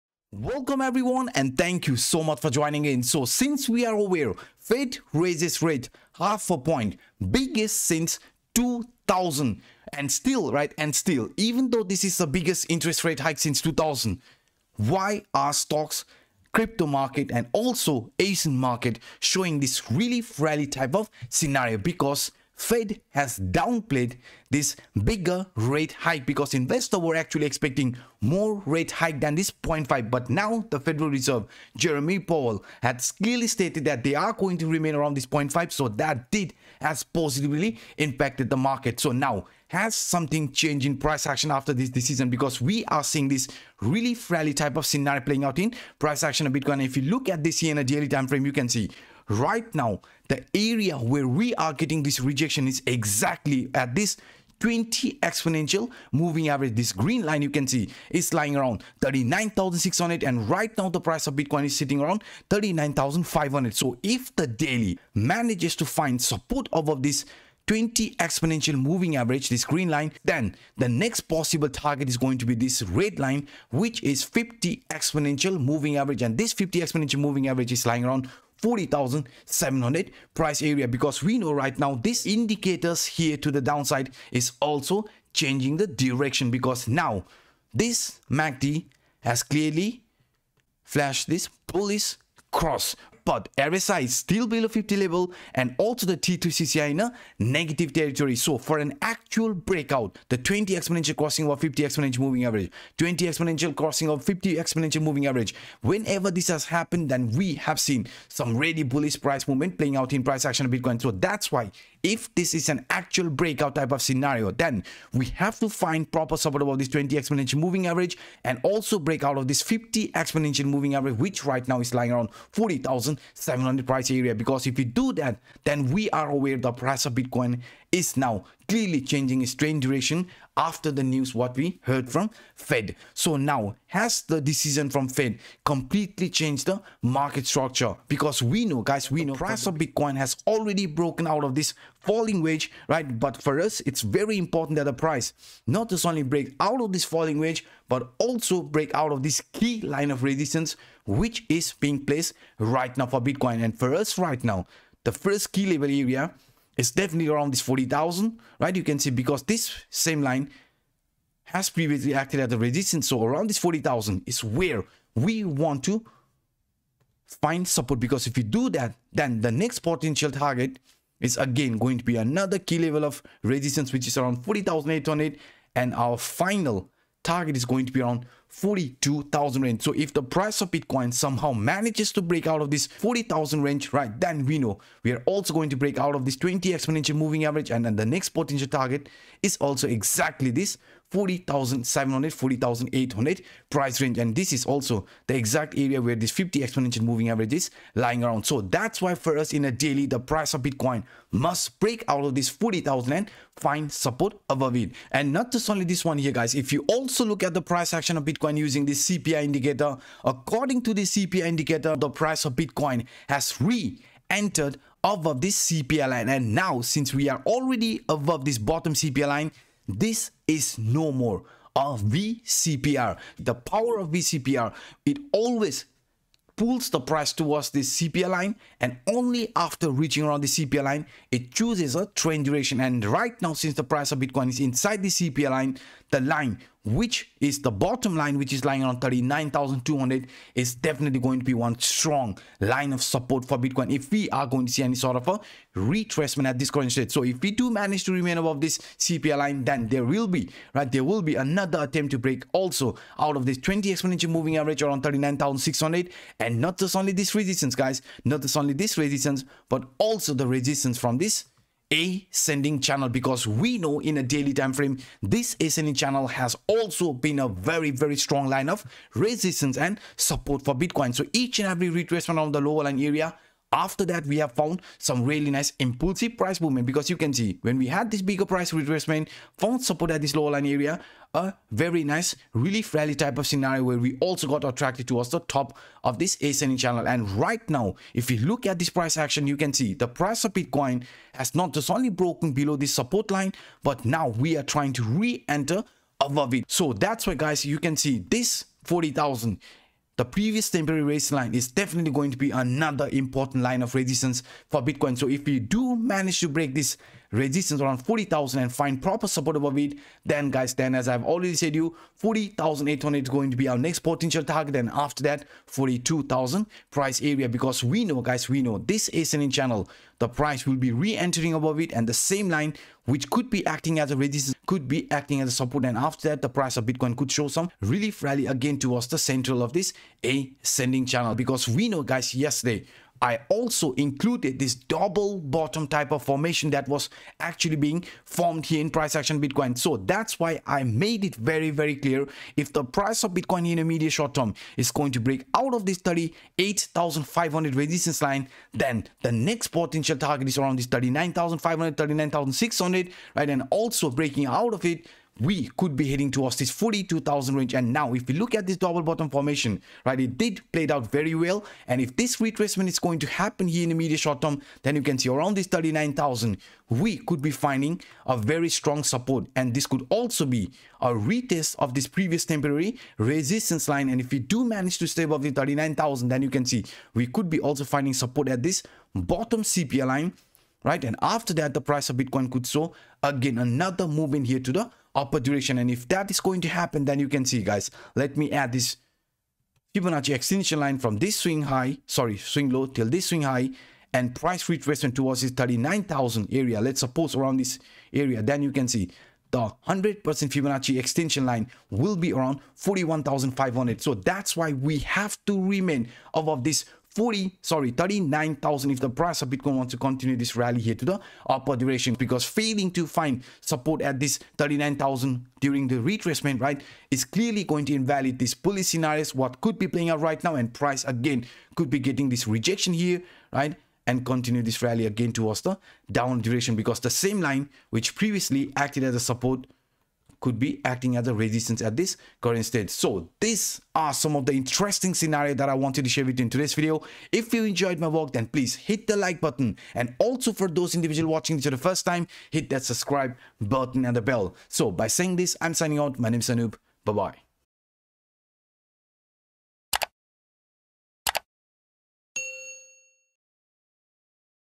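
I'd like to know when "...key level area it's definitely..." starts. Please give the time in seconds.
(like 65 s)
155 s.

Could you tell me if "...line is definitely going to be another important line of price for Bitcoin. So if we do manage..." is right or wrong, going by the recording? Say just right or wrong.
wrong.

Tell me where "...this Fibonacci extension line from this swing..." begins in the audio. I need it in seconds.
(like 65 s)
388 s.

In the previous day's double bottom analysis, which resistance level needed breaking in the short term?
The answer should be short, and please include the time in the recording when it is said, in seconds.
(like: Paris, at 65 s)
38,500, at 345 s.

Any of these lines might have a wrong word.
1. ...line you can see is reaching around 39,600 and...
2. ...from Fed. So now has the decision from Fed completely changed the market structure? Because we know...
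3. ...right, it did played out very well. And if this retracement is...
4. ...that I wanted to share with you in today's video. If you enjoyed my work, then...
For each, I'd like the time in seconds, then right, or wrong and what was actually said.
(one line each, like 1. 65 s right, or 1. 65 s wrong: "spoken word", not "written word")
1. 57 s wrong: "lying", not "reaching"
2. 132 s right
3. 360 s right
4. 435 s right.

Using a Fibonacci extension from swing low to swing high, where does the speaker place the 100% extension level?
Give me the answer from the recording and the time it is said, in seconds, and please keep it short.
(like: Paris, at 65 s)
41,500, at 402 s.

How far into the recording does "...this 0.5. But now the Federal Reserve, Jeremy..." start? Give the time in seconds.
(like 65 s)
29 s.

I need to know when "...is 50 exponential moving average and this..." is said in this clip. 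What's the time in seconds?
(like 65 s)
74 s.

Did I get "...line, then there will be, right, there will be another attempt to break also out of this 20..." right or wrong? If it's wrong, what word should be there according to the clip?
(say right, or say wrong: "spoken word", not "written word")
right.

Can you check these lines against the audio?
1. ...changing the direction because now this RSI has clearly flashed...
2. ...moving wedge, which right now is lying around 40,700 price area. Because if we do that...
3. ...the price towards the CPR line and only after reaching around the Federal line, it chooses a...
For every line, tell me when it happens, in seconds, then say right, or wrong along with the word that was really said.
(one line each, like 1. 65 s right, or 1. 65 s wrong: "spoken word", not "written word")
1. 85 s wrong: "MACD", not "RSI"
2. 120 s wrong: "average", not "wedge"
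3. 226 s wrong: "CPR", not "Federal".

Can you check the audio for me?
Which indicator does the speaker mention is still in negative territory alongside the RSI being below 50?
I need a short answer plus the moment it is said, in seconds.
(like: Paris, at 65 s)
T2CCI, at 96 s.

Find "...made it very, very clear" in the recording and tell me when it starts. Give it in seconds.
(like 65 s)
340 s.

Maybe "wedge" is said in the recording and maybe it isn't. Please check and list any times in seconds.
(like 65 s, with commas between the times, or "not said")
142 s, 147 s.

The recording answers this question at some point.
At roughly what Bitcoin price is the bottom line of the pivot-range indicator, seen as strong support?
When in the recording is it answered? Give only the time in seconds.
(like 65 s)
239 s.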